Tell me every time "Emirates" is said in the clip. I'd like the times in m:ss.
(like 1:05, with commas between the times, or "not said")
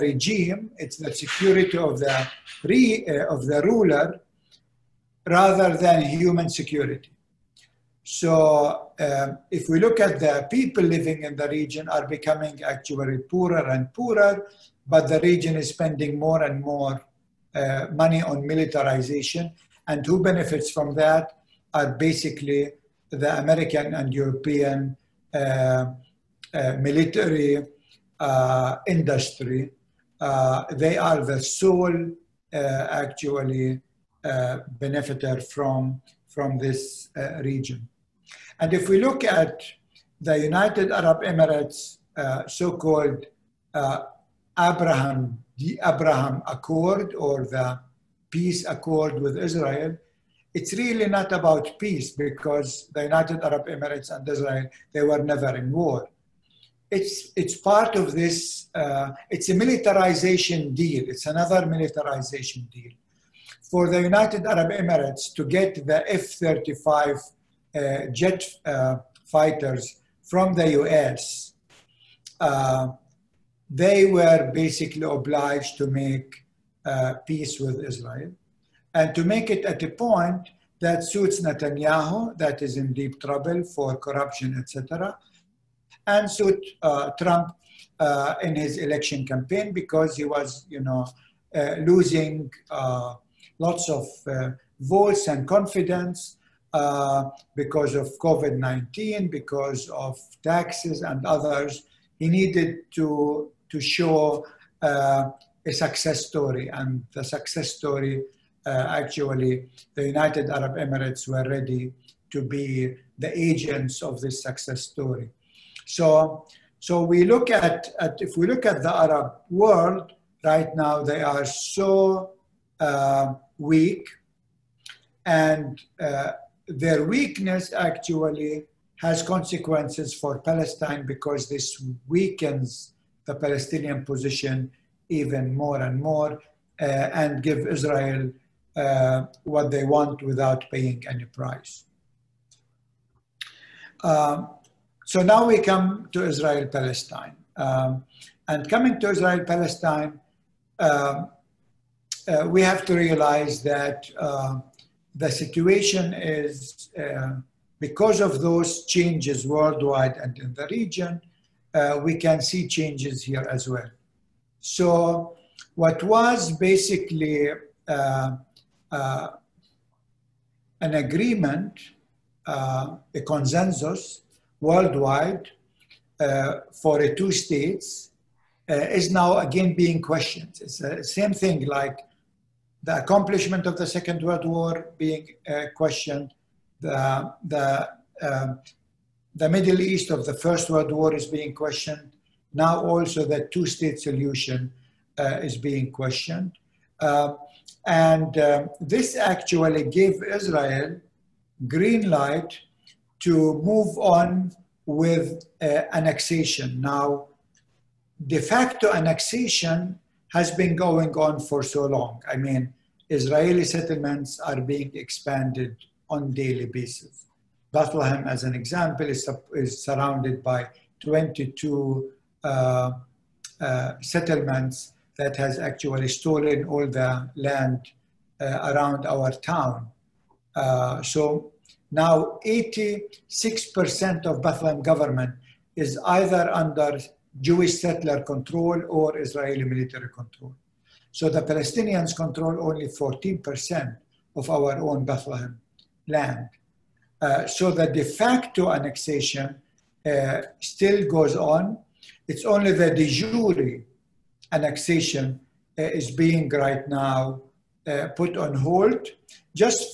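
0:41, 0:53, 1:04, 1:50.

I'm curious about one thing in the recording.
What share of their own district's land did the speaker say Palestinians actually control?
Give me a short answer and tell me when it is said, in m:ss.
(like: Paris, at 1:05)
14%, at 4:02.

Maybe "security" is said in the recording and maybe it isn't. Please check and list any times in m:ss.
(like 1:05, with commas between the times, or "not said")
0:01, 0:06.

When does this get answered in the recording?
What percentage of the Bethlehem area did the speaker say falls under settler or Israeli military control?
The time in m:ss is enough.
3:52.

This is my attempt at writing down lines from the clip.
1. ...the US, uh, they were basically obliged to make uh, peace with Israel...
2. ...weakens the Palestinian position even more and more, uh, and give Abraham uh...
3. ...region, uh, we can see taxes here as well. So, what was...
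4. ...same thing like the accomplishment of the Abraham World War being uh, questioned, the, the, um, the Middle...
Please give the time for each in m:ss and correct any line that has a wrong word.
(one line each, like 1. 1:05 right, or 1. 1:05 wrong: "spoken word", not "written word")
1. 1:10 right
2. 2:12 wrong: "Israel", not "Abraham"
3. 2:40 wrong: "changes", not "taxes"
4. 3:01 wrong: "Second", not "Abraham".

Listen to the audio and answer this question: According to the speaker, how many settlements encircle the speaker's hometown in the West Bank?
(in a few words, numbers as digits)
22.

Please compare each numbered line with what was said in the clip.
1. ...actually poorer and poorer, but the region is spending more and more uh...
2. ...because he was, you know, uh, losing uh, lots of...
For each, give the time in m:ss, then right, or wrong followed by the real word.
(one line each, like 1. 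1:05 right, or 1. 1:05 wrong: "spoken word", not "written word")
1. 0:12 right
2. 1:29 right.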